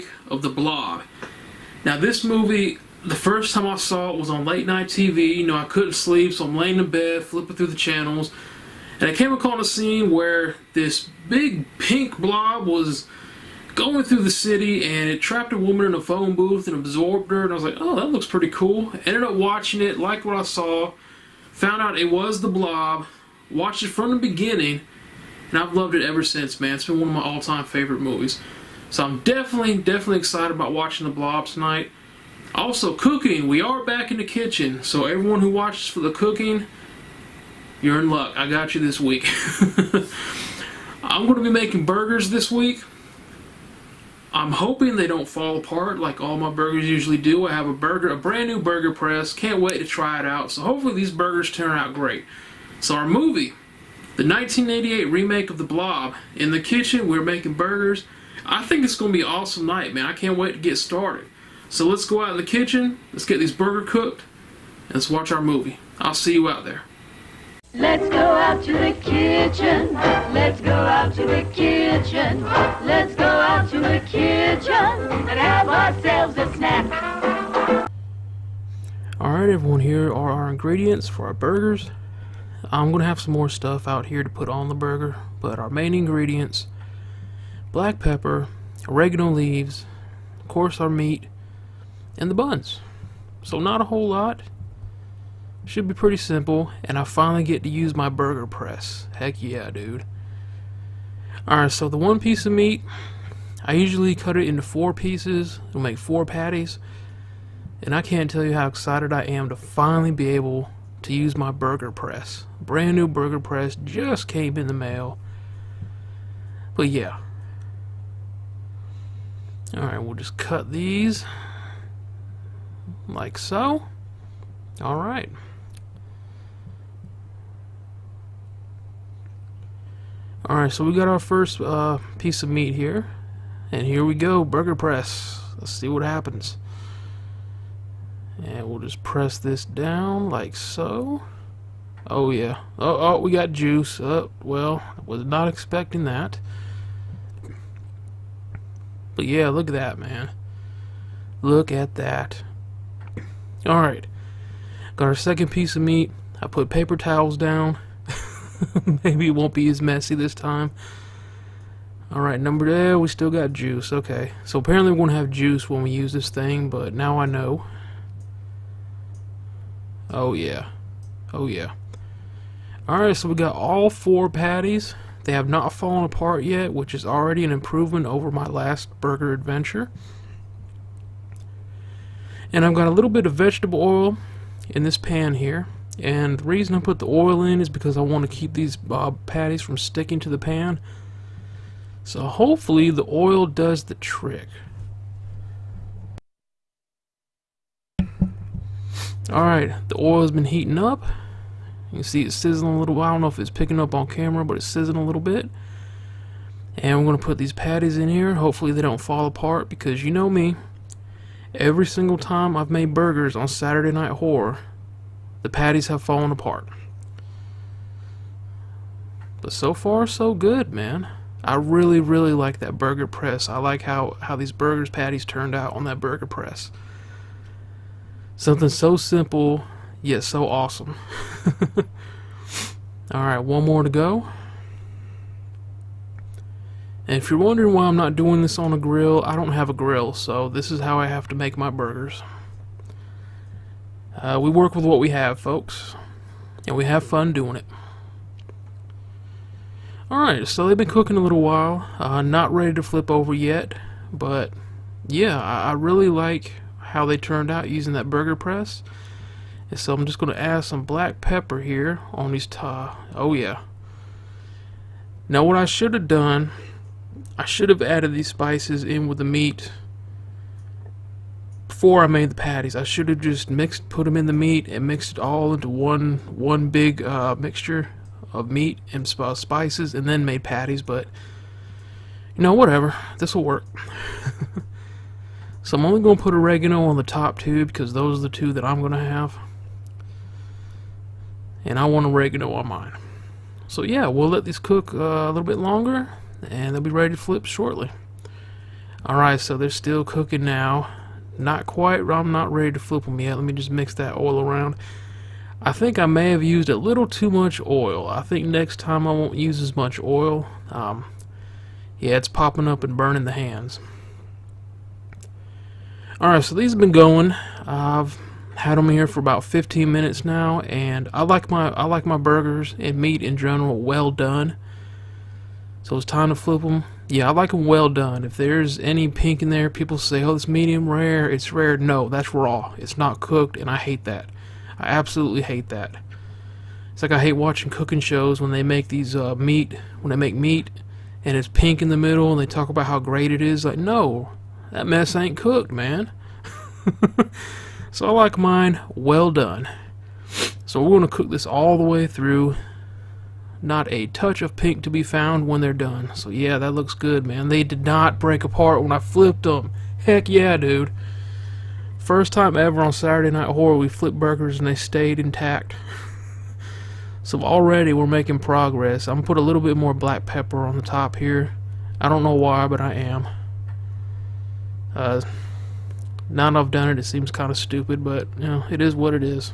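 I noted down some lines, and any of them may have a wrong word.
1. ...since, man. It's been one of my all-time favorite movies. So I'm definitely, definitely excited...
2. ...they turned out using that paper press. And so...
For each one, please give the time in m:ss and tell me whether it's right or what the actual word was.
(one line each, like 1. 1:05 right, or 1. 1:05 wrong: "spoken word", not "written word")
1. 0:26 right
2. 4:17 wrong: "burger", not "paper".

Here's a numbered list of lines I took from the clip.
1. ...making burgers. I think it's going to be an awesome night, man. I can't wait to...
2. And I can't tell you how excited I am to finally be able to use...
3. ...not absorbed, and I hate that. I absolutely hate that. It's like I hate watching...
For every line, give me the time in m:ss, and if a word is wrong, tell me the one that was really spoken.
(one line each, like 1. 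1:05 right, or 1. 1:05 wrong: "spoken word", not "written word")
1. 0:57 right
2. 1:47 right
3. 5:32 wrong: "cooked", not "absorbed".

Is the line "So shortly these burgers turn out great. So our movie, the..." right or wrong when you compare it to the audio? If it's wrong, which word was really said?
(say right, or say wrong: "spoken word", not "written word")
wrong: "hopefully", not "shortly".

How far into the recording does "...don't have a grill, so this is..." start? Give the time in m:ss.
3:59.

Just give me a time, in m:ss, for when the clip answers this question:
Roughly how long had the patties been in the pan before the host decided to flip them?
5:19.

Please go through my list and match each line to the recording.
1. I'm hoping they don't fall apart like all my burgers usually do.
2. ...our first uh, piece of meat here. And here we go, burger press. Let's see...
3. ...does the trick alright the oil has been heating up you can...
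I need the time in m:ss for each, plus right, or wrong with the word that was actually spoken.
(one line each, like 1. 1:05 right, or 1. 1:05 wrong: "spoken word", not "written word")
1. 0:44 right
2. 2:11 right
3. 3:13 right.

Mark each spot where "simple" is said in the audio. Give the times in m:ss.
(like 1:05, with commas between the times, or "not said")
1:36, 3:48.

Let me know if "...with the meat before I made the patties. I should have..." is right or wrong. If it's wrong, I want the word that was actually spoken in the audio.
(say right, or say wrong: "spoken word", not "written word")
right.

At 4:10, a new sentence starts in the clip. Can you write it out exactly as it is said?
Alright, so they've been cooking a little while.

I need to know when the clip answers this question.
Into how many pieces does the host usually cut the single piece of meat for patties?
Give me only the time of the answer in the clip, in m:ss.
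1:44.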